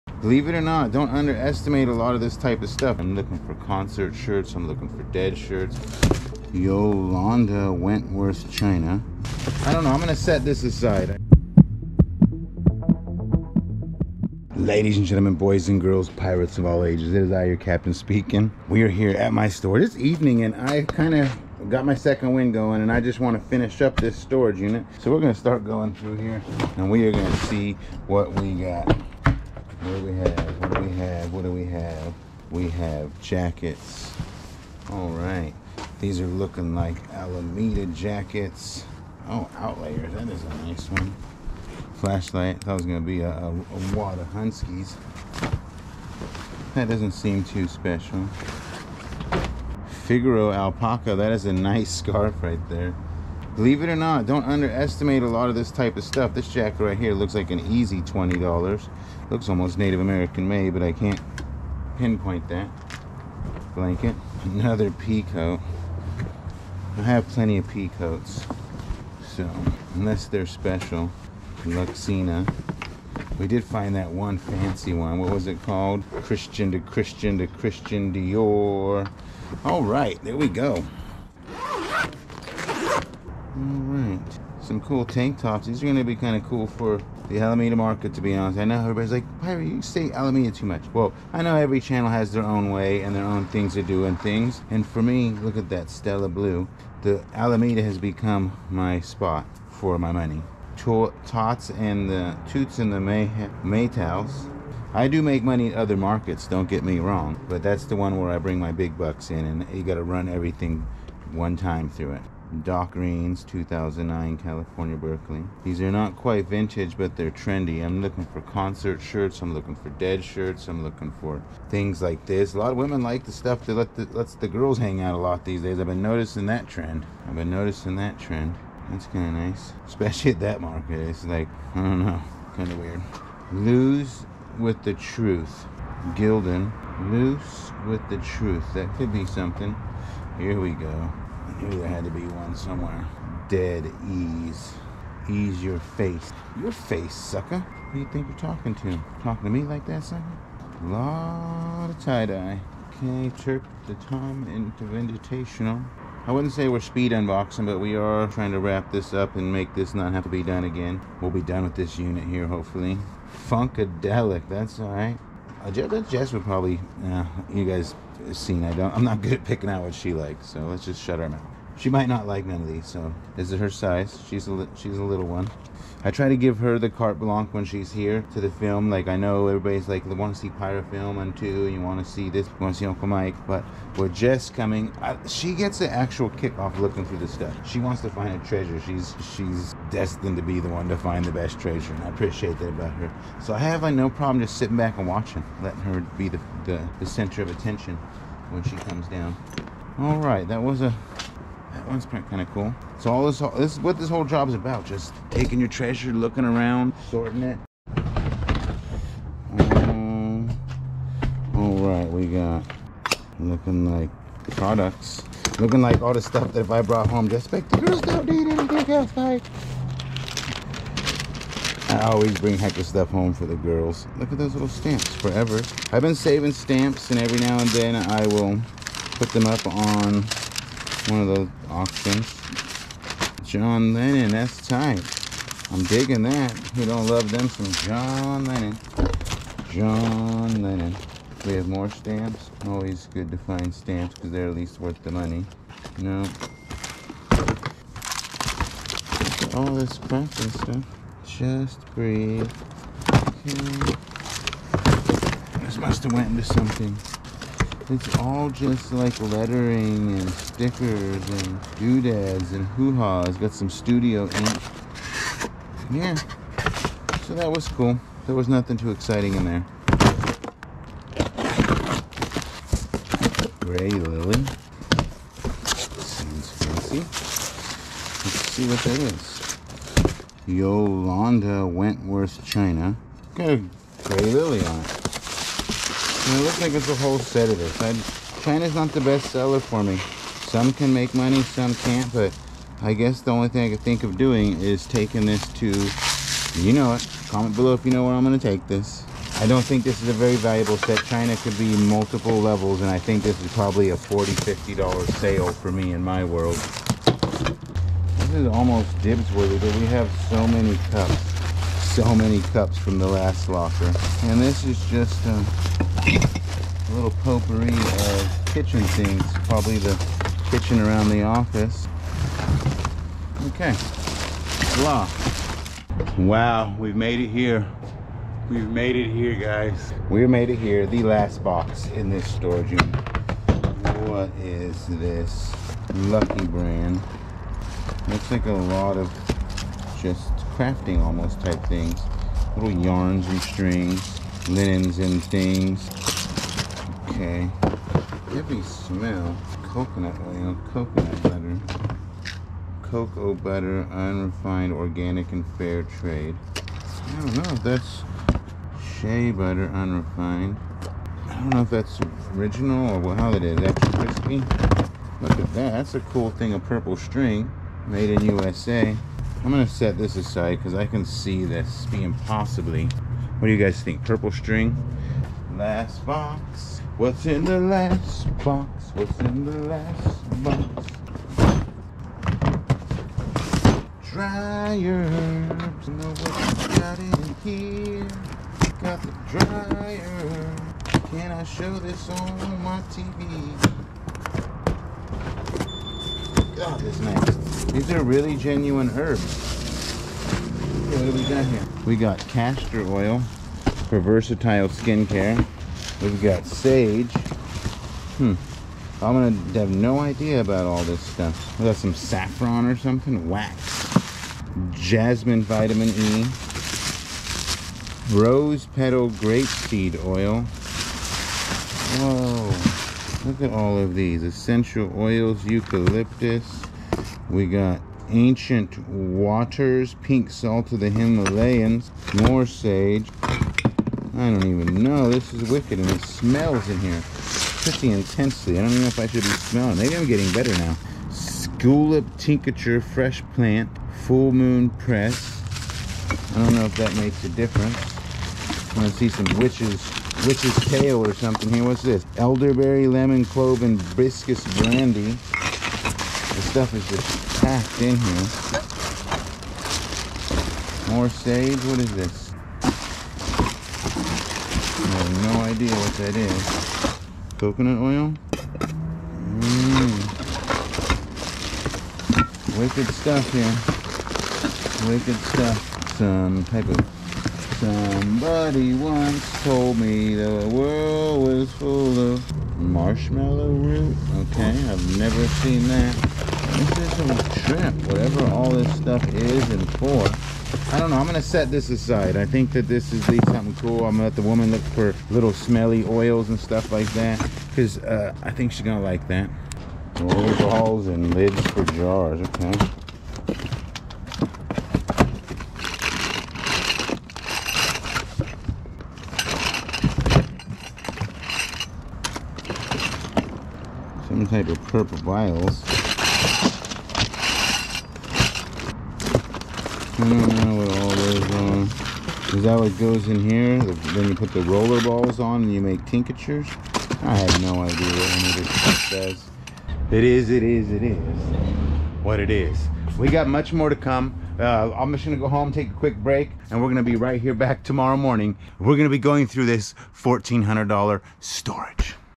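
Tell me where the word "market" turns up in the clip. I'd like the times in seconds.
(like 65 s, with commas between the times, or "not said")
87 s, 105 s, 130 s.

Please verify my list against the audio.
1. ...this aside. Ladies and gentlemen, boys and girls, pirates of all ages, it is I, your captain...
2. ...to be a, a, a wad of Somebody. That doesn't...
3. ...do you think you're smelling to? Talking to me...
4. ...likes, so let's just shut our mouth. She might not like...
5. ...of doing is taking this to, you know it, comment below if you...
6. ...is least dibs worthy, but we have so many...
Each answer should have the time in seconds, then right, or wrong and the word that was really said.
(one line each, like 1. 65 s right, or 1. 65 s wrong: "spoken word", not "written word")
1. 10 s right
2. 42 s wrong: "Hunskies", not "Somebody"
3. 147 s wrong: "talking", not "smelling"
4. 170 s right
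5. 294 s right
6. 308 s wrong: "almost", not "least".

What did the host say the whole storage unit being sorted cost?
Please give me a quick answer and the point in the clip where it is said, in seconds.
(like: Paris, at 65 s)
$1,400, at 539 s.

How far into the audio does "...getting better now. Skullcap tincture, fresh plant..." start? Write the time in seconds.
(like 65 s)
440 s.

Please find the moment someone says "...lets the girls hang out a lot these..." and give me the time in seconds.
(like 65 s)
124 s.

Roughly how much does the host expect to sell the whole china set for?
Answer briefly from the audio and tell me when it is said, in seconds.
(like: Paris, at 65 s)
$40-$50, at 303 s.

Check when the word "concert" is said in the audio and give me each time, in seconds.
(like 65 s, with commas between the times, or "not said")
3 s, 118 s.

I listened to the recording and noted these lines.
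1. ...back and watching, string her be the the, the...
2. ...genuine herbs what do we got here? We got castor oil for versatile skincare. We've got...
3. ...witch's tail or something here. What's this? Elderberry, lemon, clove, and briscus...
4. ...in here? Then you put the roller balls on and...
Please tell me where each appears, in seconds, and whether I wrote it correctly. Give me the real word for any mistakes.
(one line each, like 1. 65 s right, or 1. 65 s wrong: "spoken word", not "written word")
1. 194 s wrong: "letting", not "string"
2. 398 s right
3. 450 s right
4. 523 s right.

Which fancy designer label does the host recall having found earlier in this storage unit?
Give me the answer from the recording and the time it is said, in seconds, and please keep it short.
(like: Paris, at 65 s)
Christian Dior, at 77 s.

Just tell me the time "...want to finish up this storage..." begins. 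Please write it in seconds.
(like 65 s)
23 s.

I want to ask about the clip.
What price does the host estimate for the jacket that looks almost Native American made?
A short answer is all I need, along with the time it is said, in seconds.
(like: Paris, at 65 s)
$20, at 58 s.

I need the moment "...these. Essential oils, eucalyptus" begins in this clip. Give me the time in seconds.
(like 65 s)
423 s.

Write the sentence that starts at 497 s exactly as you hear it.
Because uh, I think she's going to like that.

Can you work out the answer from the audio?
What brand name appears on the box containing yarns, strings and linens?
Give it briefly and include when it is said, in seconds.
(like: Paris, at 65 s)
Lucky Brand, at 335 s.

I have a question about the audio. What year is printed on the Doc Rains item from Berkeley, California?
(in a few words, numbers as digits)
2009.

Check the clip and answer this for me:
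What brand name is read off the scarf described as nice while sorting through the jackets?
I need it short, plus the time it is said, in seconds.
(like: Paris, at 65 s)
Figaro alpaca, at 50 s.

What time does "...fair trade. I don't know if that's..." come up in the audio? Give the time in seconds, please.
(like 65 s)
355 s.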